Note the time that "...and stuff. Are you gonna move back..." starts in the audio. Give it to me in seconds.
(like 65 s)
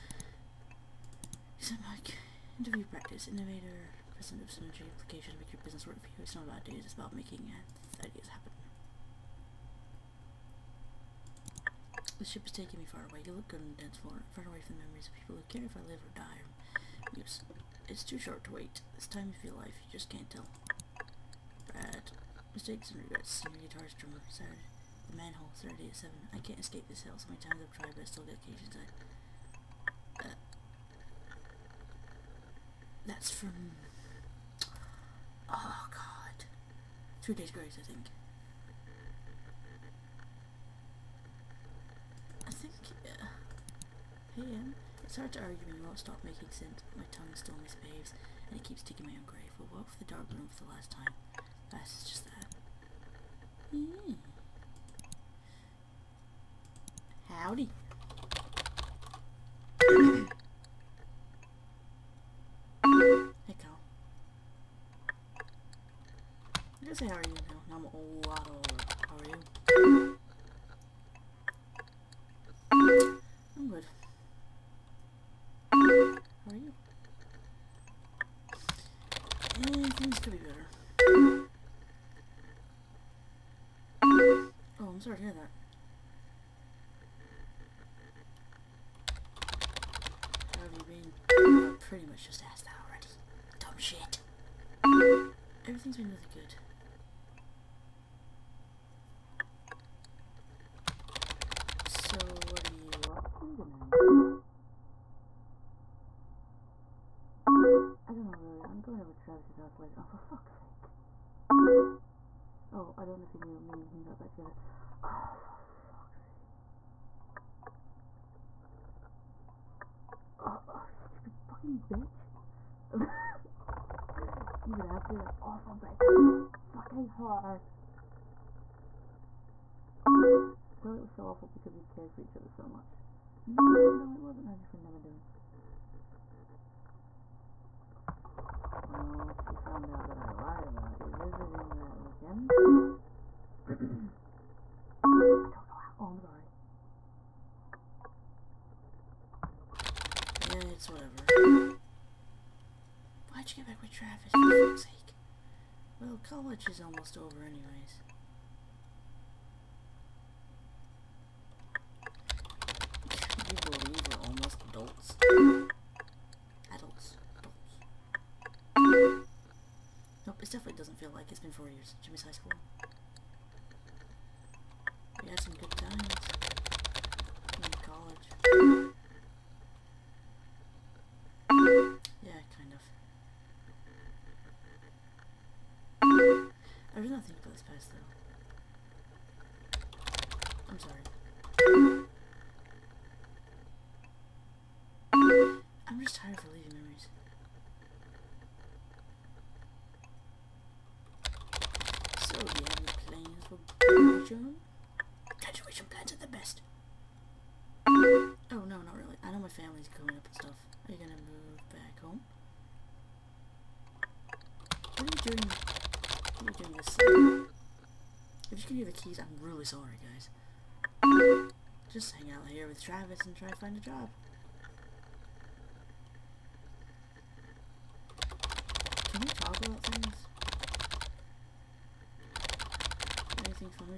210 s.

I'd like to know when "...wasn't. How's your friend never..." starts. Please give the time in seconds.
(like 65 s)
134 s.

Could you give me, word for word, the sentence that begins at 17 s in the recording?
It's, it's too short to wait.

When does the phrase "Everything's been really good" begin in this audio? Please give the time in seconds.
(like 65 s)
95 s.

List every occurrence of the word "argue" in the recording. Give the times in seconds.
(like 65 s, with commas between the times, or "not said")
45 s.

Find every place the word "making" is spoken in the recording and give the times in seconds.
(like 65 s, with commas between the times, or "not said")
7 s, 46 s.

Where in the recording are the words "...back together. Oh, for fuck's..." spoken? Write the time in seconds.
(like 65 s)
114 s.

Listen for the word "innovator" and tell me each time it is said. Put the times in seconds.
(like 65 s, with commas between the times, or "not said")
3 s.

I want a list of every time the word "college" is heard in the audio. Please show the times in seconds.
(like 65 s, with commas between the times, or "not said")
156 s.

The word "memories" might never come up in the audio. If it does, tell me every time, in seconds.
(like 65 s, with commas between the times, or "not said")
14 s, 196 s.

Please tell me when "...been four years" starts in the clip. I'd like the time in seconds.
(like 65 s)
171 s.